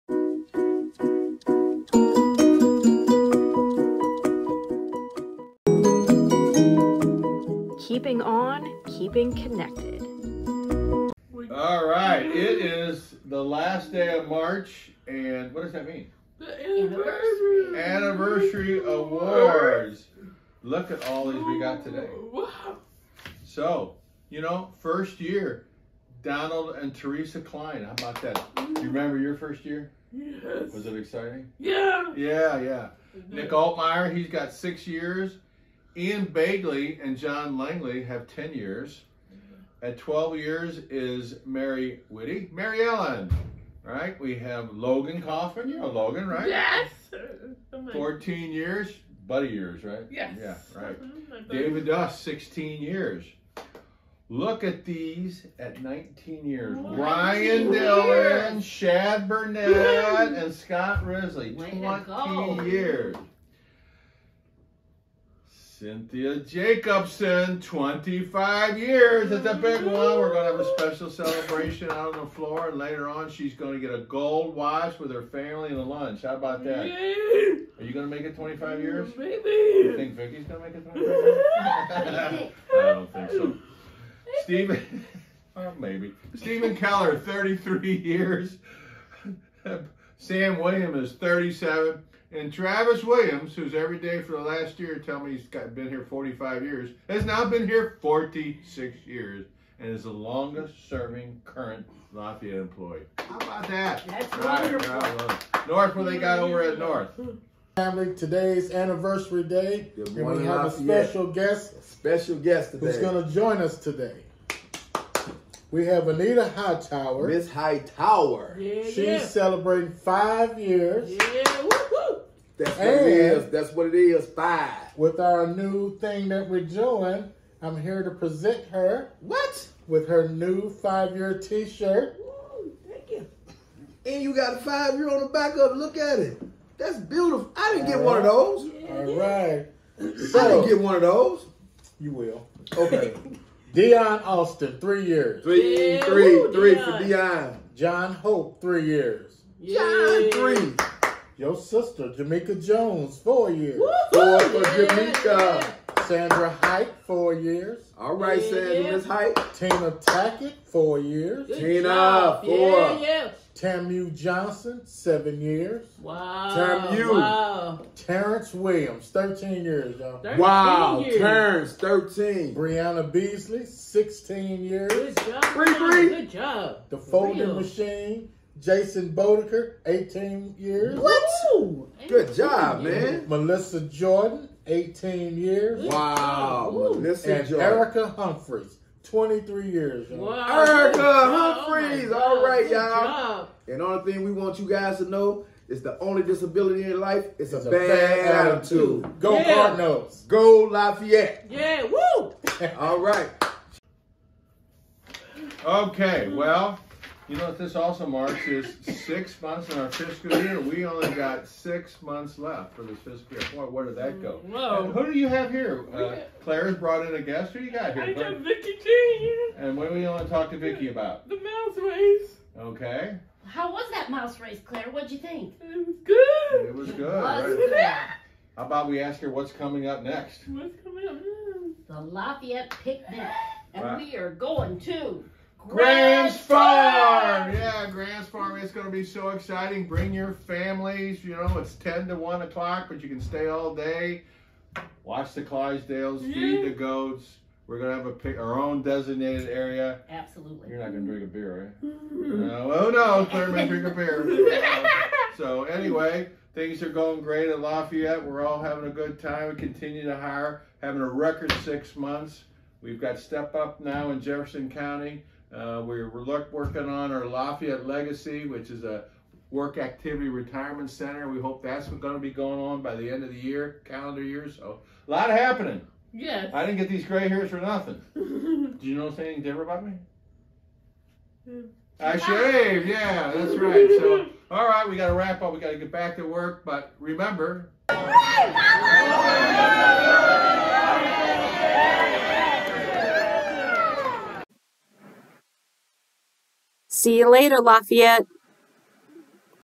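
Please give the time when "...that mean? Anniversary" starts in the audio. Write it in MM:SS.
00:15.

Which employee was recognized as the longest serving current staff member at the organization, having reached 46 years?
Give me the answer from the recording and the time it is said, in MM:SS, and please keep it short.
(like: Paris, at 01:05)
Travis Williams, at 01:32.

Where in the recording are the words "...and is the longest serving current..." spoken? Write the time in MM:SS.
01:39.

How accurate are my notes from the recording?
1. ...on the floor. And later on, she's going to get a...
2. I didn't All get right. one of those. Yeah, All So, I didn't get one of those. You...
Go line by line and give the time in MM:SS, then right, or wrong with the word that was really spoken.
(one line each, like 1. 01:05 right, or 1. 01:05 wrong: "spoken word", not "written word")
1. 01:12 right
2. 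02:17 right.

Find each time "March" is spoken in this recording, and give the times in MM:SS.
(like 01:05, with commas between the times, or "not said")
00:14.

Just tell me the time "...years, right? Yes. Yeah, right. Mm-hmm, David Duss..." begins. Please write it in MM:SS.
00:49.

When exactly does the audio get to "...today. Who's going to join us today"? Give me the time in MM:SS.
01:52.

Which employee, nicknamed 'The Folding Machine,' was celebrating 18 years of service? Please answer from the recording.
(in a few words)
Jason Bodeker.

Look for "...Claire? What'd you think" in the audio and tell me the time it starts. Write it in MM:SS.
03:44.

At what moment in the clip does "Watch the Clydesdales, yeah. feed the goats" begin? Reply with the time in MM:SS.
04:05.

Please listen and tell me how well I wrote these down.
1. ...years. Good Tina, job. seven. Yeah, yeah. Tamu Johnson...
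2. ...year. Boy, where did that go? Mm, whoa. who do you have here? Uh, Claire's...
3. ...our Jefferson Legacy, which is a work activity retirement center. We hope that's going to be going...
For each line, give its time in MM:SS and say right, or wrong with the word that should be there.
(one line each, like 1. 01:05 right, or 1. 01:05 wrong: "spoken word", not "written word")
1. 02:40 wrong: "four", not "seven"
2. 03:33 right
3. 04:27 wrong: "Lafayette", not "Jefferson".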